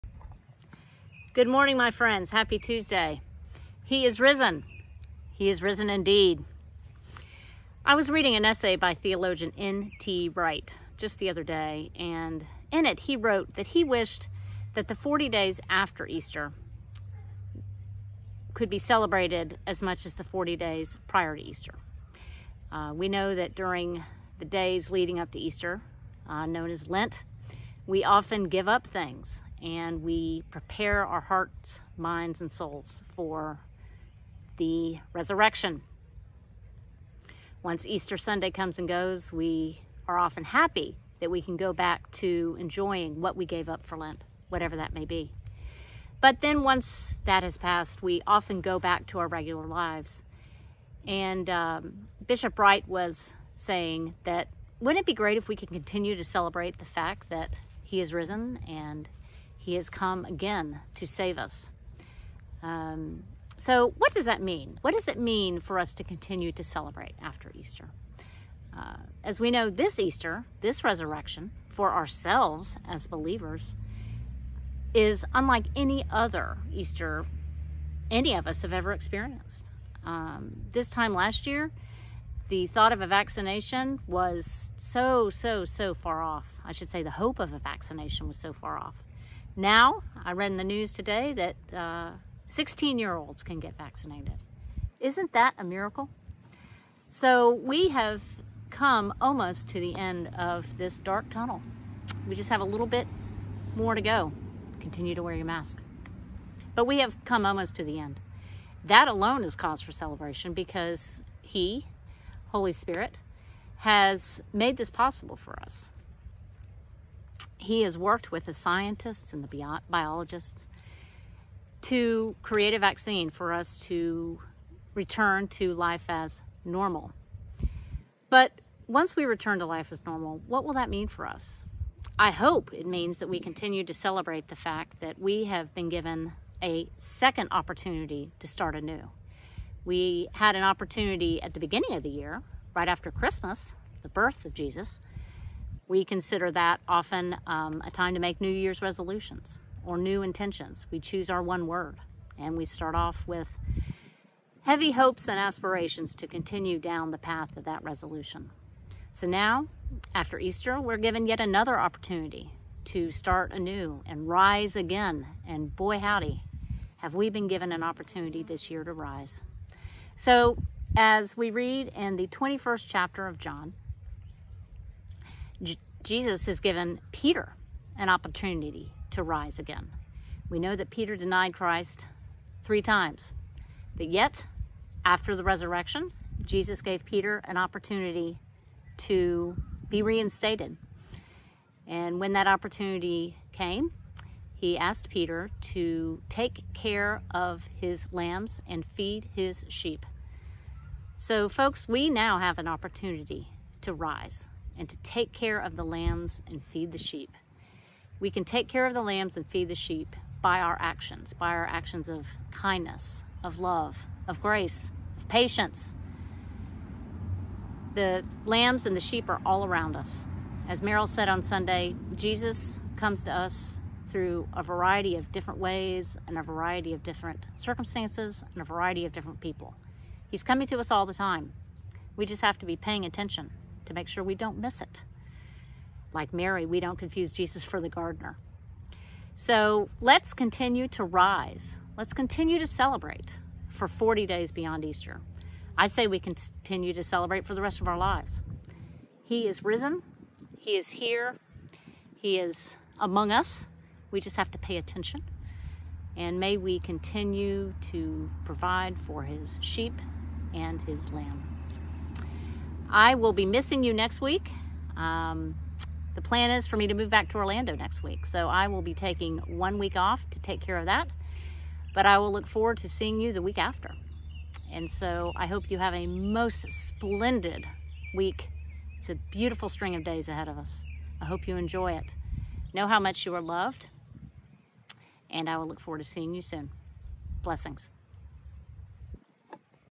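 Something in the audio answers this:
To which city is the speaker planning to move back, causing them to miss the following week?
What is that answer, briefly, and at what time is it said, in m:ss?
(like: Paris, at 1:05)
Orlando, at 4:27.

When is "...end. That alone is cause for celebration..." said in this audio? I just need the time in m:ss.
1:48.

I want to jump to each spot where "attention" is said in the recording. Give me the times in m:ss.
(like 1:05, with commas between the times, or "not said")
3:53, 4:14.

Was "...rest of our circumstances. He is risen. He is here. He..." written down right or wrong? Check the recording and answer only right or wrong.
wrong.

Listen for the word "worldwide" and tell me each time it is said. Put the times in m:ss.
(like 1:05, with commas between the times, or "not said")
not said.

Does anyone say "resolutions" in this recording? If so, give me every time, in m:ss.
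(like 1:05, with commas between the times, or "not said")
2:28, 2:37.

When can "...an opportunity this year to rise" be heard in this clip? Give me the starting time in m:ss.
2:47.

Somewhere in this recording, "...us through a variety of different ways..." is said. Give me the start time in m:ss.
3:43.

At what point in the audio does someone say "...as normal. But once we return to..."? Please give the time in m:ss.
2:06.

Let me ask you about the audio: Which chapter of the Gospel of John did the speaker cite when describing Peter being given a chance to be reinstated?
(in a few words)
21st.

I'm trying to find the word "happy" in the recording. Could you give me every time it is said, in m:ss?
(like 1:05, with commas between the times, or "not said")
0:02, 0:40.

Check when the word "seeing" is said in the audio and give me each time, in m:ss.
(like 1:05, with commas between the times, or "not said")
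4:32, 4:46.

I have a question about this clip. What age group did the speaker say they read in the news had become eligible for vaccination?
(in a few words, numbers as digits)
16-year-olds.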